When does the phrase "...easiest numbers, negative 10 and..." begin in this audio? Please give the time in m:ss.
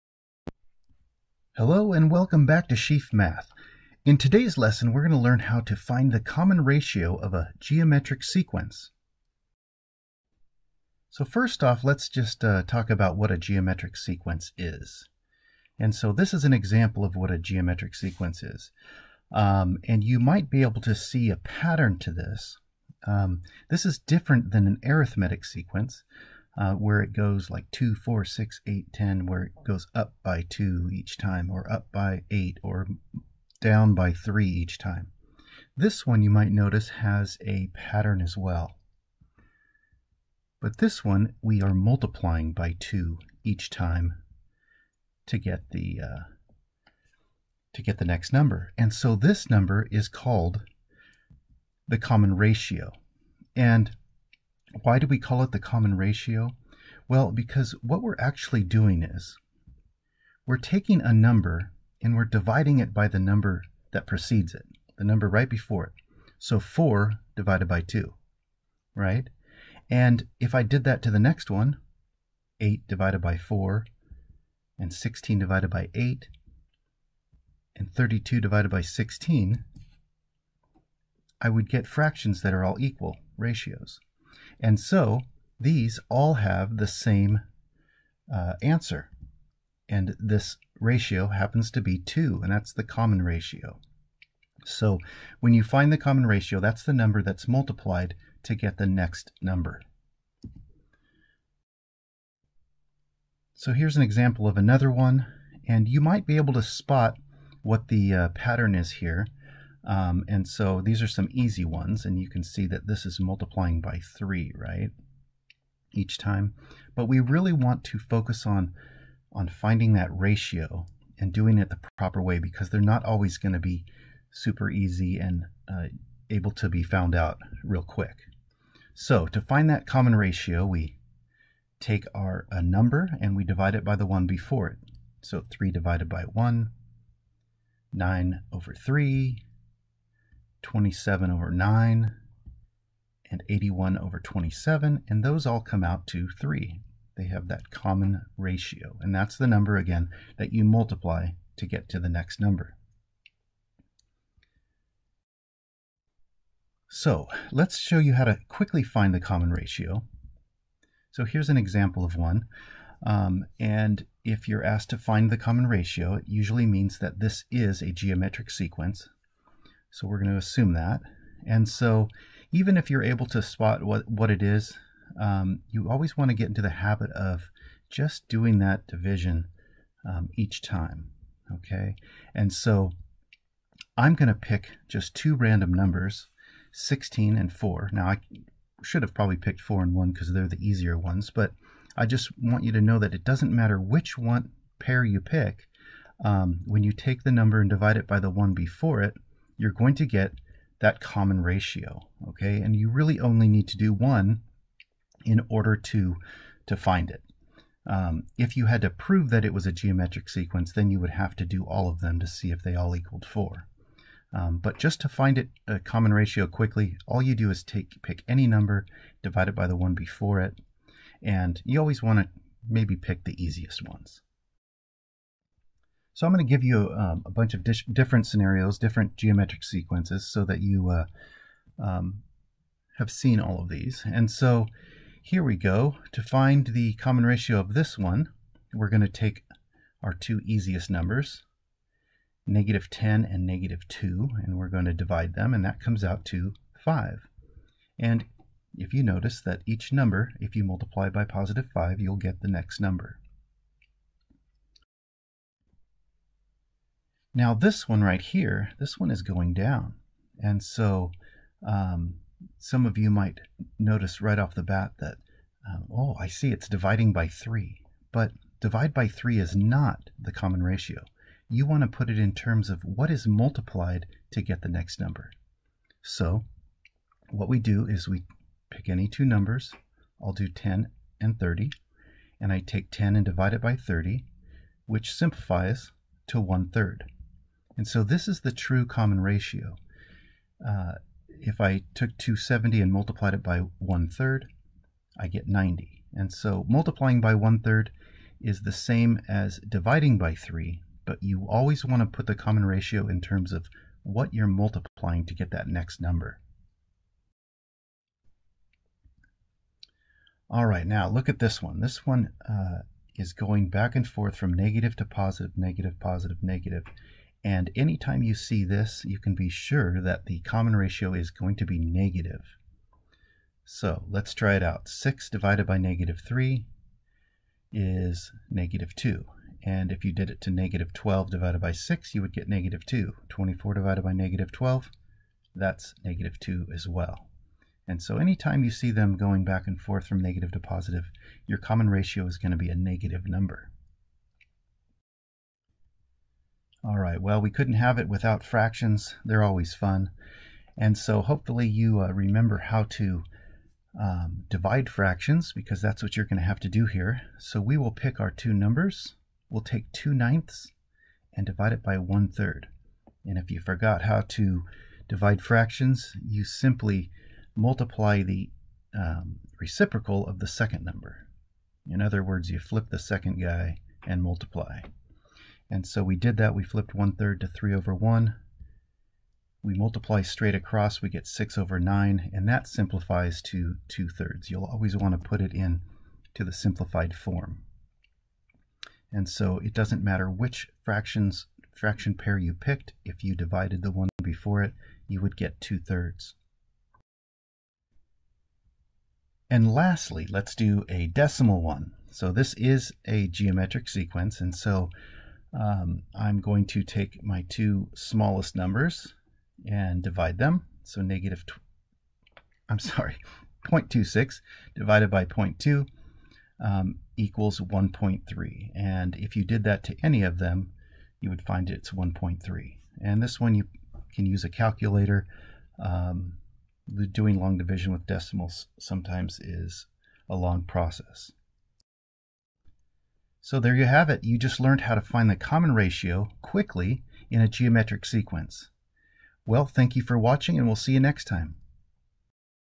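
4:00.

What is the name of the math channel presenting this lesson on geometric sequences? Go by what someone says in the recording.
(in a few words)
Sheaff Math.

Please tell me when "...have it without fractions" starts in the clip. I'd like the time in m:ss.
5:47.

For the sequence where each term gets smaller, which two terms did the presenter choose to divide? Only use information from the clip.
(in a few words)
10 and 30.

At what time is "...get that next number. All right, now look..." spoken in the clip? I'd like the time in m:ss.
5:05.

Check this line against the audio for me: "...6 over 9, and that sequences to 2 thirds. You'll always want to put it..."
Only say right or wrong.
wrong.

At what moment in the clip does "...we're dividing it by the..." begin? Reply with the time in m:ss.
1:02.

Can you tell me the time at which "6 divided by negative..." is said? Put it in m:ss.
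5:24.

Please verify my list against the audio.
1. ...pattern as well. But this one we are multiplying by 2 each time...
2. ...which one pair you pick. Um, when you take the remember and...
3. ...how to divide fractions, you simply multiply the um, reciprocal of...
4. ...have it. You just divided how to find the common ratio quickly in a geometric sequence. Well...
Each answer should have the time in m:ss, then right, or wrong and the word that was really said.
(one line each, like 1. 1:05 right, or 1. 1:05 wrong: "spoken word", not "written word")
1. 0:37 right
2. 3:13 wrong: "number", not "remember"
3. 6:04 right
4. 7:13 wrong: "learned", not "divided".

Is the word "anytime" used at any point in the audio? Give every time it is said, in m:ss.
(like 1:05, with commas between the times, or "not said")
5:17, 5:38.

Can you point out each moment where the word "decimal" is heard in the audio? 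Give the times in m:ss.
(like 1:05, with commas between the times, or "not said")
6:41, 7:08.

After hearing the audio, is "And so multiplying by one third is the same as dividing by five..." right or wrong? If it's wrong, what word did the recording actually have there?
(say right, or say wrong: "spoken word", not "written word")
wrong: "three", not "five".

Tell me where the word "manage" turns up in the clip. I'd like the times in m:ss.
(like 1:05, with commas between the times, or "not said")
not said.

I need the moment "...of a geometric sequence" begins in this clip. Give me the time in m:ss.
0:07.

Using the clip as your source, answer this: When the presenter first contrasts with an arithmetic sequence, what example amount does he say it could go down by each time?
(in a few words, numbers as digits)
3.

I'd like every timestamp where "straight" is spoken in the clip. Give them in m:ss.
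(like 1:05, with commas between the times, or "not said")
6:20.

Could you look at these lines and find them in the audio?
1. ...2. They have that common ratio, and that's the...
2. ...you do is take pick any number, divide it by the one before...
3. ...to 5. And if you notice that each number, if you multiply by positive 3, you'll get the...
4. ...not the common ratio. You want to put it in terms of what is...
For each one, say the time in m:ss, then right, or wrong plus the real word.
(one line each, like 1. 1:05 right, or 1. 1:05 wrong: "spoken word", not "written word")
1. 2:26 wrong: "3", not "2"
2. 3:37 right
3. 4:06 wrong: "5", not "3"
4. 4:29 right.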